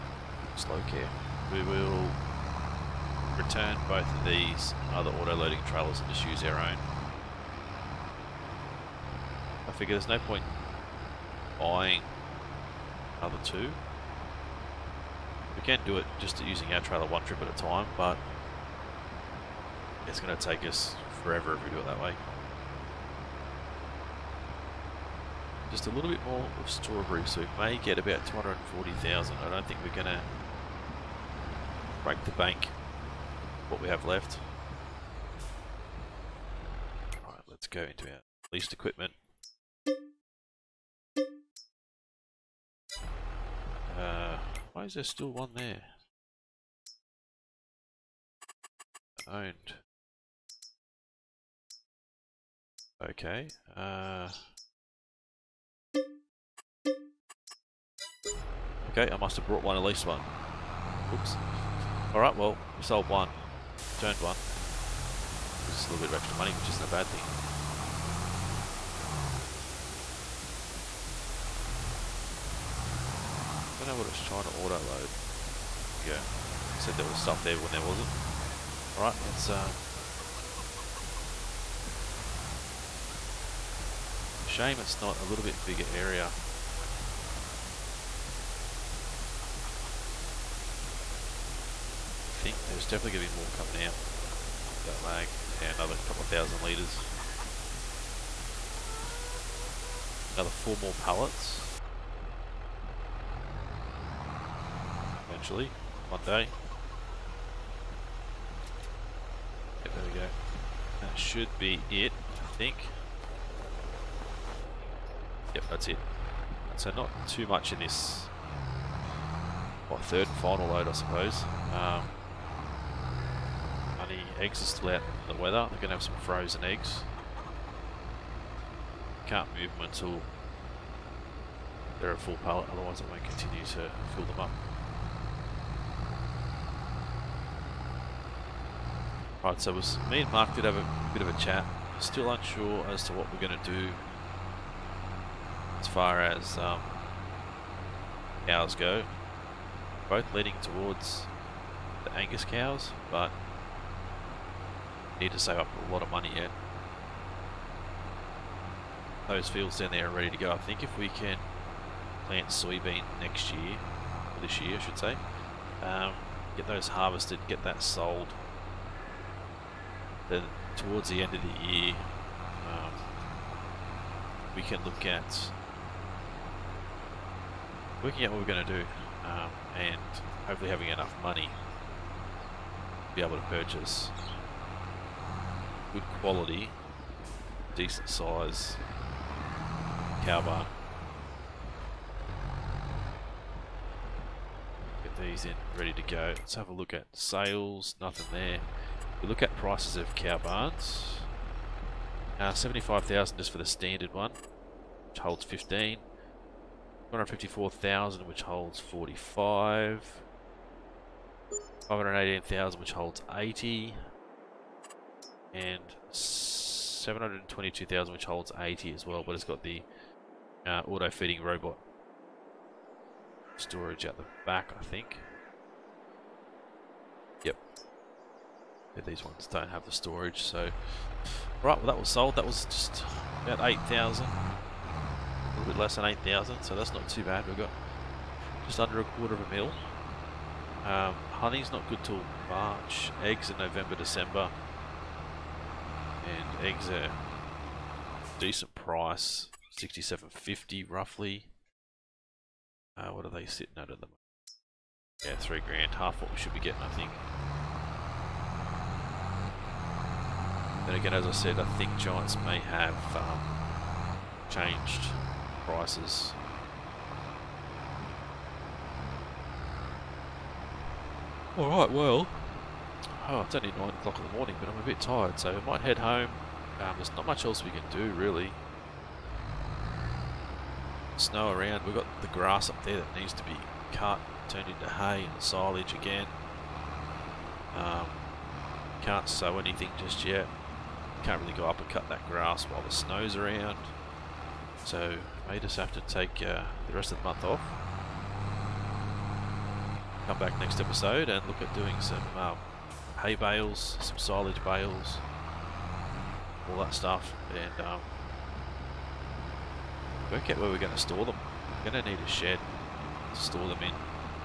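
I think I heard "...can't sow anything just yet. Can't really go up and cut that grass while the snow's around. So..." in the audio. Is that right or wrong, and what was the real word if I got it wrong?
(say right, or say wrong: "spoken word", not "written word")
right.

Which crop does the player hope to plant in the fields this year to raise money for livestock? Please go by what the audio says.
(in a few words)
soybean.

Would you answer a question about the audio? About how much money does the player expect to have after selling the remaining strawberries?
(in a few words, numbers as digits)
240,000.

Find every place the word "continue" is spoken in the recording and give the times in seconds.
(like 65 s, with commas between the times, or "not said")
133 s.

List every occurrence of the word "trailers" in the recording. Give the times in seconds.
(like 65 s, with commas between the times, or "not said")
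5 s, 16 s.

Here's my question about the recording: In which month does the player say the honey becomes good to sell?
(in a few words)
March.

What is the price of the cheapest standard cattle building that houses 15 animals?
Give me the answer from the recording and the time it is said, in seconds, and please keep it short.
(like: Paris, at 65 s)
75,000, at 202 s.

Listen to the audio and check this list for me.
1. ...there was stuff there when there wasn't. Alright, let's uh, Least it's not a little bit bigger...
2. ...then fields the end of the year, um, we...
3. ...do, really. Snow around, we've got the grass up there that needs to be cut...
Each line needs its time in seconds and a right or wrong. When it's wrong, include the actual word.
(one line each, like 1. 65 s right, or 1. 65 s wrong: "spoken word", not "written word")
1. 76 s wrong: "Shame", not "Least"
2. 170 s wrong: "towards", not "fields"
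3. 277 s right.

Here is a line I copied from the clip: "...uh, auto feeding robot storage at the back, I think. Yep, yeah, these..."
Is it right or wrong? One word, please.
right.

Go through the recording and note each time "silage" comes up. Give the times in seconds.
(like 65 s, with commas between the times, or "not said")
285 s, 304 s.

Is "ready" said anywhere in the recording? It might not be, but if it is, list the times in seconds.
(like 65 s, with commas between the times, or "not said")
160 s, 195 s.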